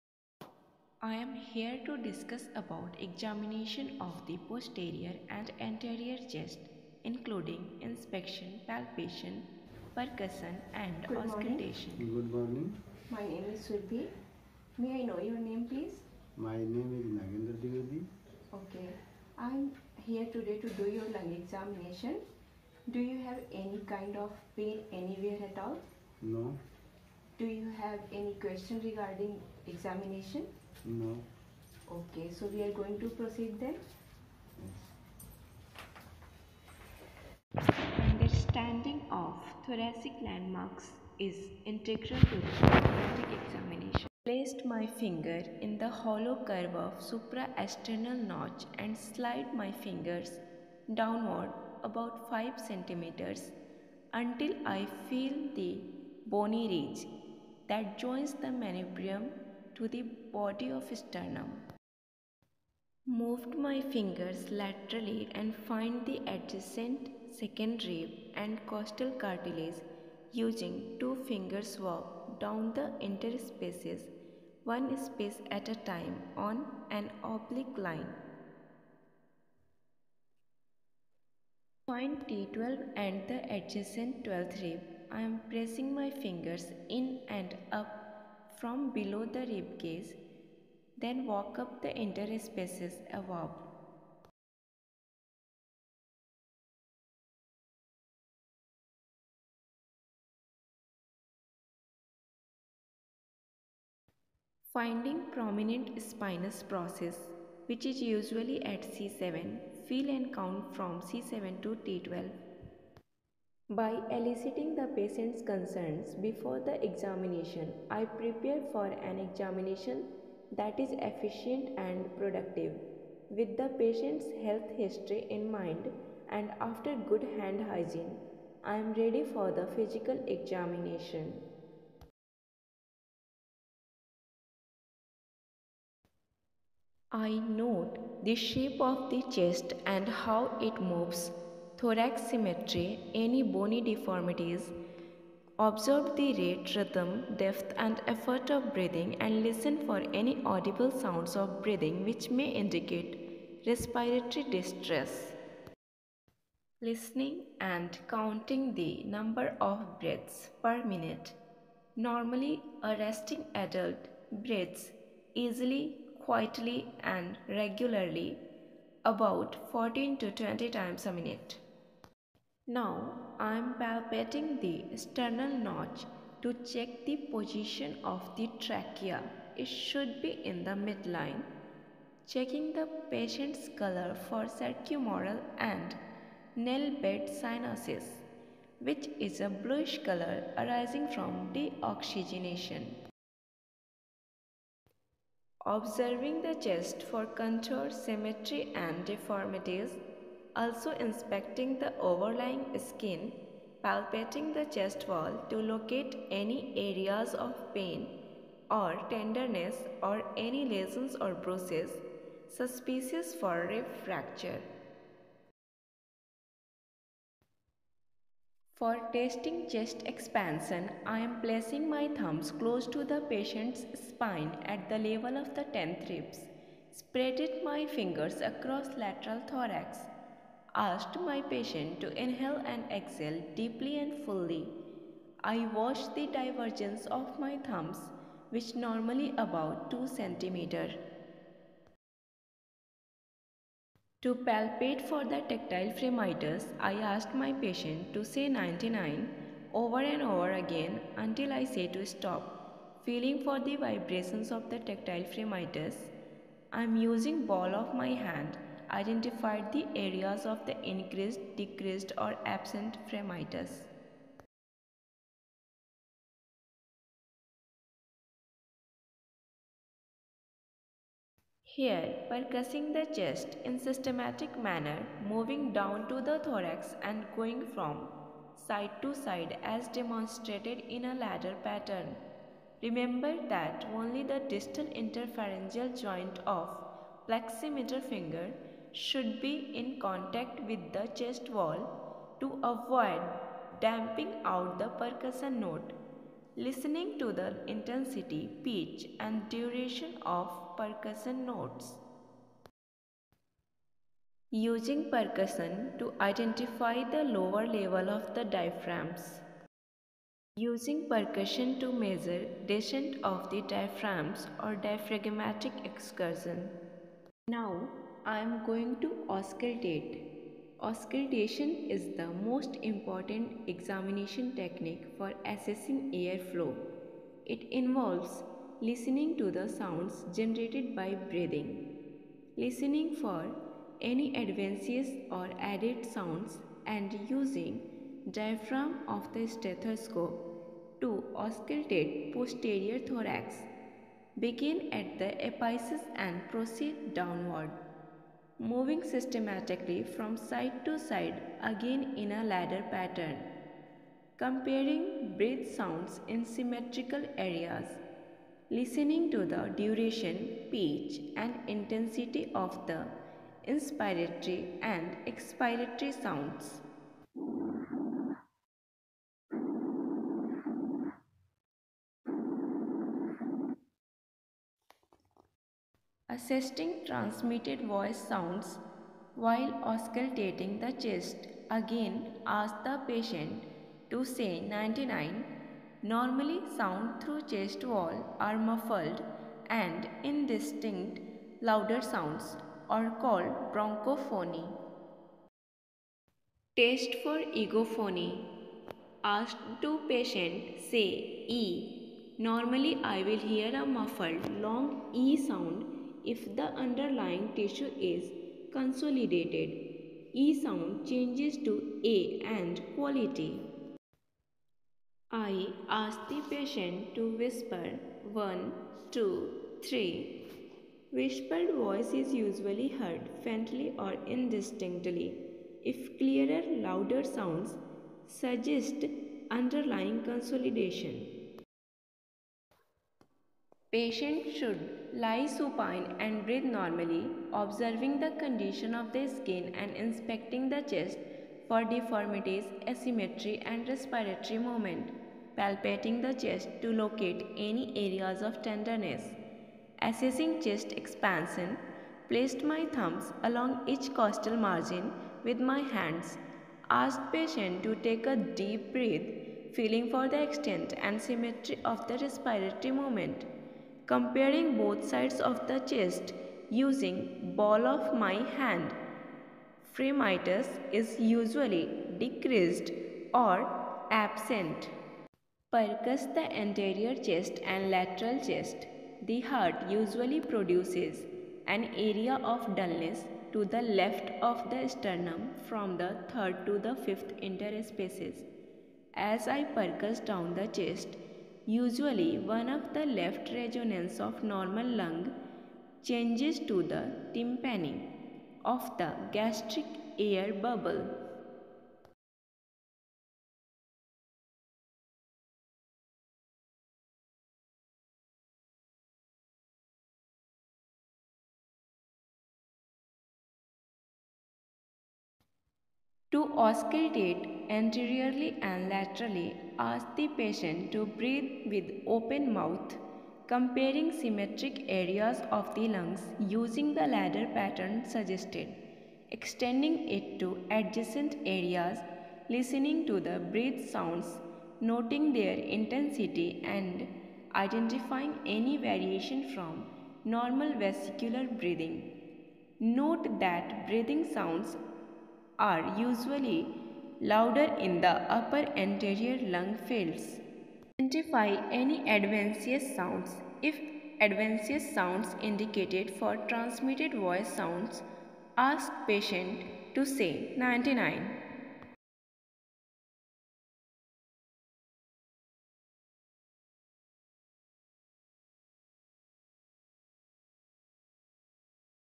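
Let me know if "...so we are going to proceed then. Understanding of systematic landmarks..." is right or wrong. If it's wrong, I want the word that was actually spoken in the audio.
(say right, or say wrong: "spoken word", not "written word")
wrong: "thoracic", not "systematic".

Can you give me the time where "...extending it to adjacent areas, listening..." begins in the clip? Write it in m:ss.
8:49.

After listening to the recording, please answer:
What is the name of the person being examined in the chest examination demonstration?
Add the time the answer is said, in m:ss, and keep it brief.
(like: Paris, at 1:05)
Nagendra Dwivedi, at 0:17.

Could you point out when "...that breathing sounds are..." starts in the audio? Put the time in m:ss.
9:03.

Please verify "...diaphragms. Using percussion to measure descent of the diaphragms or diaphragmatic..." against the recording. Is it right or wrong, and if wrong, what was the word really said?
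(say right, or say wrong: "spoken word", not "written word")
right.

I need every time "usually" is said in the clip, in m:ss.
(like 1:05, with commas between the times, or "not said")
1:48, 7:02, 7:51, 7:59, 8:11, 9:05.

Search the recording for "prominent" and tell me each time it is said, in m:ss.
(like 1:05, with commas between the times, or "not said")
1:45.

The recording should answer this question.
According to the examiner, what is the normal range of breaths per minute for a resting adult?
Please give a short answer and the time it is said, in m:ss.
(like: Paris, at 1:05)
14 to 20, at 2:49.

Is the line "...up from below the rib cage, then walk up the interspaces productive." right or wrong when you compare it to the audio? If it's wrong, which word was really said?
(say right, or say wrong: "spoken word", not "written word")
wrong: "above", not "productive".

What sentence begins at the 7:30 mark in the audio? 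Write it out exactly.
Assessing chest expansion, placed my thumbs along each costal margin with my hands.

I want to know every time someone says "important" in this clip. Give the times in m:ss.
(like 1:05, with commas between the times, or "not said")
5:22.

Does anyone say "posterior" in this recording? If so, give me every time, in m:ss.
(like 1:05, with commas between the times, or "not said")
0:04, 5:42.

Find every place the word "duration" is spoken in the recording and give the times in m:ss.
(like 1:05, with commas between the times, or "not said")
4:59, 5:59.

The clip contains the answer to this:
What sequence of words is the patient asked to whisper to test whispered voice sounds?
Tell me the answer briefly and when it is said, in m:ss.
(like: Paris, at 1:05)
1, 2, 3, at 6:58.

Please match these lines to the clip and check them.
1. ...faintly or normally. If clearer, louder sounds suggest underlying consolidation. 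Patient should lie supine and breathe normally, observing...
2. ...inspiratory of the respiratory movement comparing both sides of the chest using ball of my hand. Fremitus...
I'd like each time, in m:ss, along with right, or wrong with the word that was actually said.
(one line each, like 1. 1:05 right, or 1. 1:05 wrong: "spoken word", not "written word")
1. 7:03 wrong: "indistinctly", not "normally"
2. 7:41 wrong: "symmetry", not "inspiratory".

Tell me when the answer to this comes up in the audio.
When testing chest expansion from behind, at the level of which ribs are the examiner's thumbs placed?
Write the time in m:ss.
3:45.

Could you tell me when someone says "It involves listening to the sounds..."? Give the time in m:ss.
5:27.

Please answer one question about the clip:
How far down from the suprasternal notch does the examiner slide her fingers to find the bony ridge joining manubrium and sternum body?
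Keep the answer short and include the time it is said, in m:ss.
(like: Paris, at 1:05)
5 centimeters, at 0:52.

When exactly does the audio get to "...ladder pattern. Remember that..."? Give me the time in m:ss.
4:41.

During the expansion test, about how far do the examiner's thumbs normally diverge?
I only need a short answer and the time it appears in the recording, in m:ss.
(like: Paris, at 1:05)
2 cm, at 3:59.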